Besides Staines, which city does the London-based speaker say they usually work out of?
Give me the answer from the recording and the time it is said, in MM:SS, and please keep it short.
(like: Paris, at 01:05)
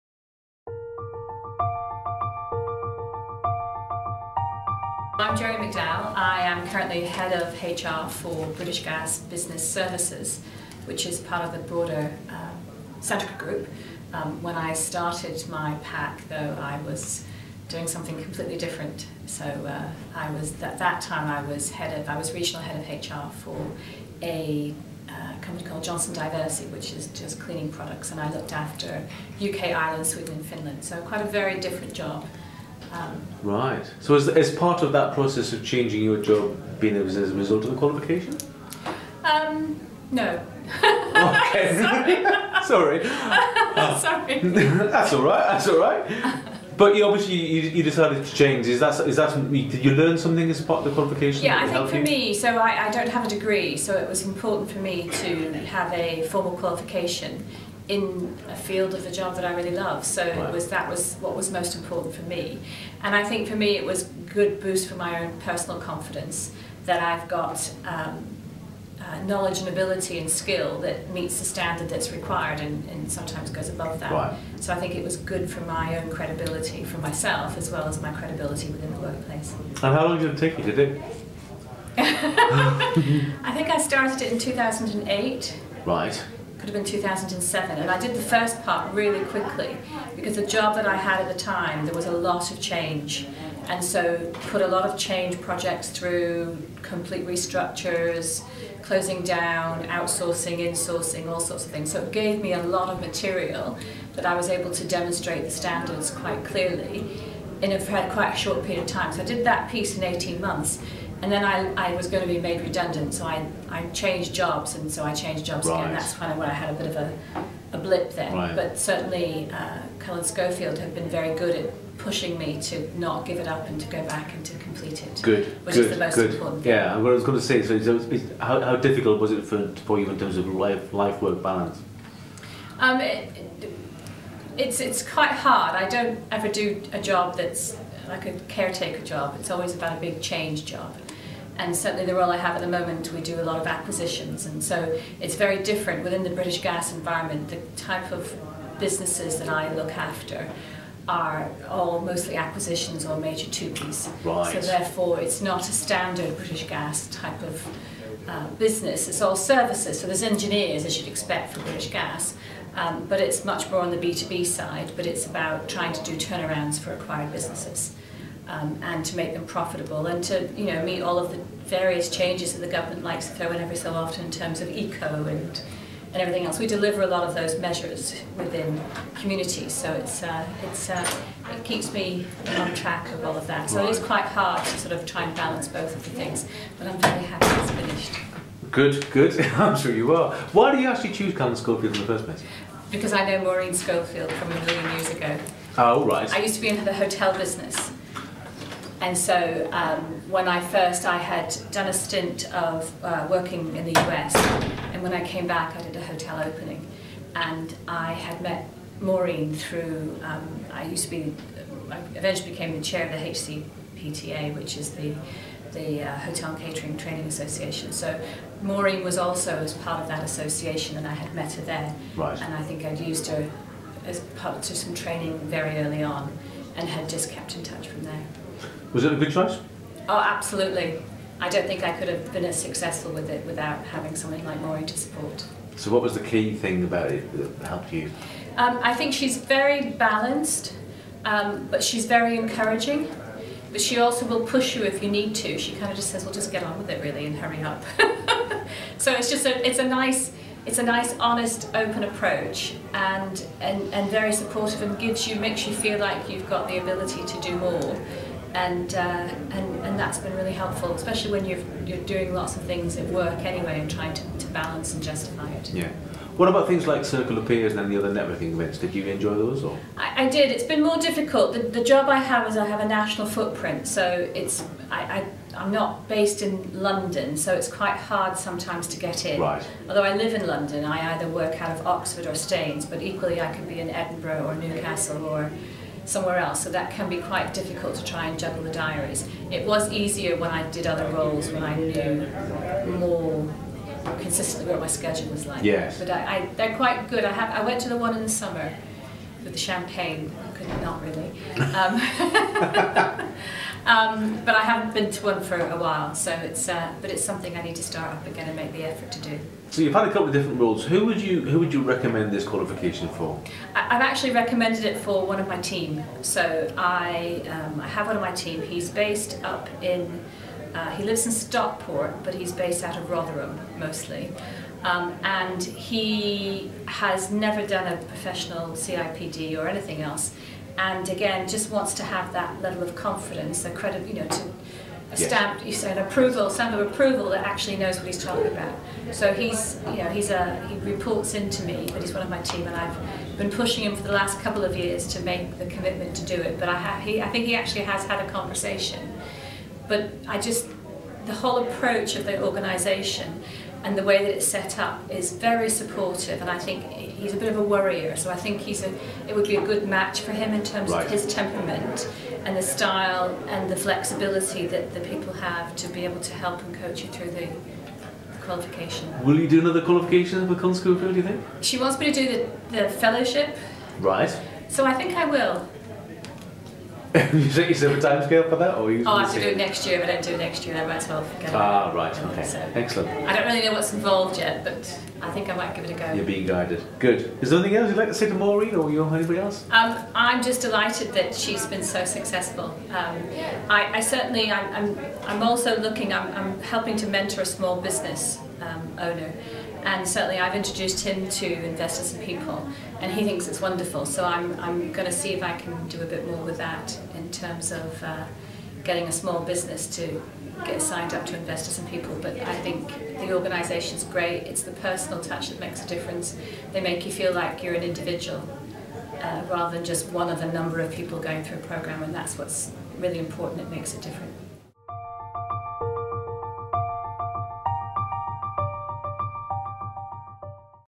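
Oxford, at 04:41.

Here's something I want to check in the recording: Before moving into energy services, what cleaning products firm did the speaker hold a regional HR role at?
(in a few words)
Johnson Diversey.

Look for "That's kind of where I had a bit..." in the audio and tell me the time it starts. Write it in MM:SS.
01:55.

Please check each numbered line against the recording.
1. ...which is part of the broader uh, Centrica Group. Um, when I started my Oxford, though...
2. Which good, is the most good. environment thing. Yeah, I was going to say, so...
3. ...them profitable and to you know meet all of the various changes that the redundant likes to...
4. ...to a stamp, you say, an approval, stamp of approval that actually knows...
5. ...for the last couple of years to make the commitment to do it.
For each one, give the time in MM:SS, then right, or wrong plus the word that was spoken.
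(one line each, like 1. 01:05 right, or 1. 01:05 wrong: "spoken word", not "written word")
1. 00:10 wrong: "PAC", not "Oxford"
2. 02:05 wrong: "important", not "environment"
3. 02:49 wrong: "government", not "redundant"
4. 05:34 right
5. 05:43 right.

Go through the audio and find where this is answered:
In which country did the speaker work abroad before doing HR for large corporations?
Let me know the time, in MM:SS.
03:23.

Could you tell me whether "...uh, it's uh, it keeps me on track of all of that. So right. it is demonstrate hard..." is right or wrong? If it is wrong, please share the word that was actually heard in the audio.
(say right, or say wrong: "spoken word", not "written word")
wrong: "quite", not "demonstrate".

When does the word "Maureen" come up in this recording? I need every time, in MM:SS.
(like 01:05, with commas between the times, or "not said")
03:13, 03:29, 03:38, 03:54, 06:28.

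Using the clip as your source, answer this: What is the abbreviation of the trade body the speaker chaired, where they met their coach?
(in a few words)
HCPTA.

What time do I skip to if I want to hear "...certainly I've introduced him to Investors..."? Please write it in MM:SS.
06:40.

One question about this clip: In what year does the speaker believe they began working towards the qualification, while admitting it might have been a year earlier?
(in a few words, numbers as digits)
2008.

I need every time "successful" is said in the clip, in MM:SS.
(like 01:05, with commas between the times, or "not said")
03:52, 06:32.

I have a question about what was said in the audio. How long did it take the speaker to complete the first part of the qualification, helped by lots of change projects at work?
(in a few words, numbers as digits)
18 months.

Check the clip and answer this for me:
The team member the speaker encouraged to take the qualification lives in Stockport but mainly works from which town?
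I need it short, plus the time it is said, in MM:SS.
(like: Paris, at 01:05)
Rotherham, at 05:23.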